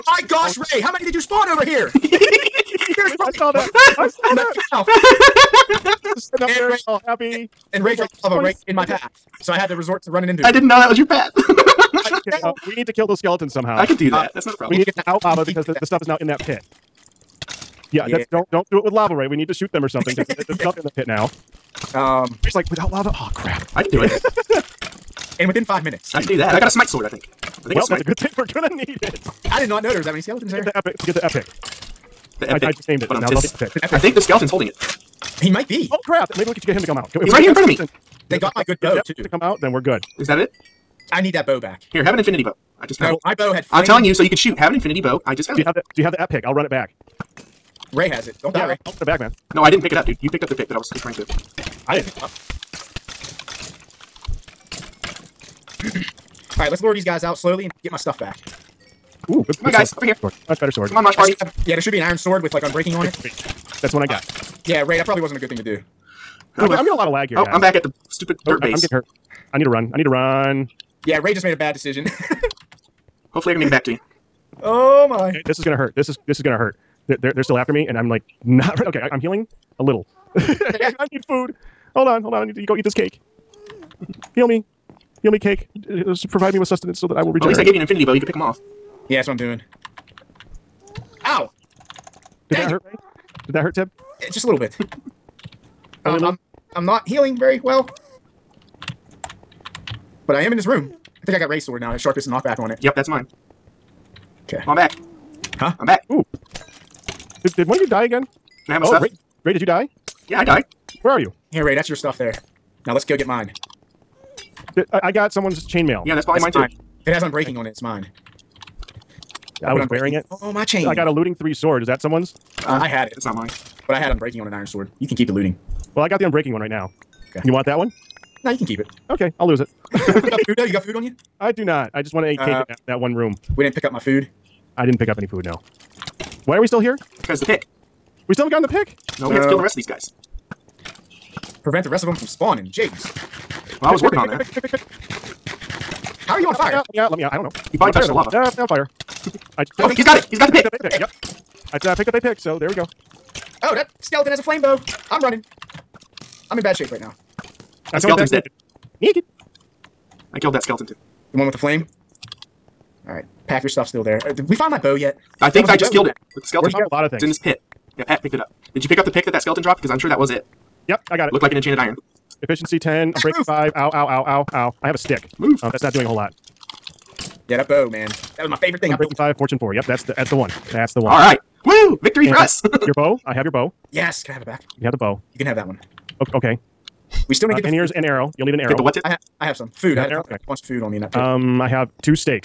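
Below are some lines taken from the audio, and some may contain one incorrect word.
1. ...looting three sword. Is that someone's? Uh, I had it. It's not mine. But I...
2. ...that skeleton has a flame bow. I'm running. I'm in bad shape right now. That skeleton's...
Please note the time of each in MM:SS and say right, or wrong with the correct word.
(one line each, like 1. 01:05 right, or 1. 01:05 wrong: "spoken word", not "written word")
1. 02:01 right
2. 02:33 right.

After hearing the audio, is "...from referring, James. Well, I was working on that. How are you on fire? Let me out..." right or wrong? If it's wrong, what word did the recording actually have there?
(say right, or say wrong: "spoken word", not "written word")
wrong: "spawning", not "referring".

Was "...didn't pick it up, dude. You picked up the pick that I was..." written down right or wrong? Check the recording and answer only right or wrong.
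right.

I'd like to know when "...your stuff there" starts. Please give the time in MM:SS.
01:51.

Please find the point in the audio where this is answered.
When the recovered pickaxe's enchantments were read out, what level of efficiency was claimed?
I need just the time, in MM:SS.
02:52.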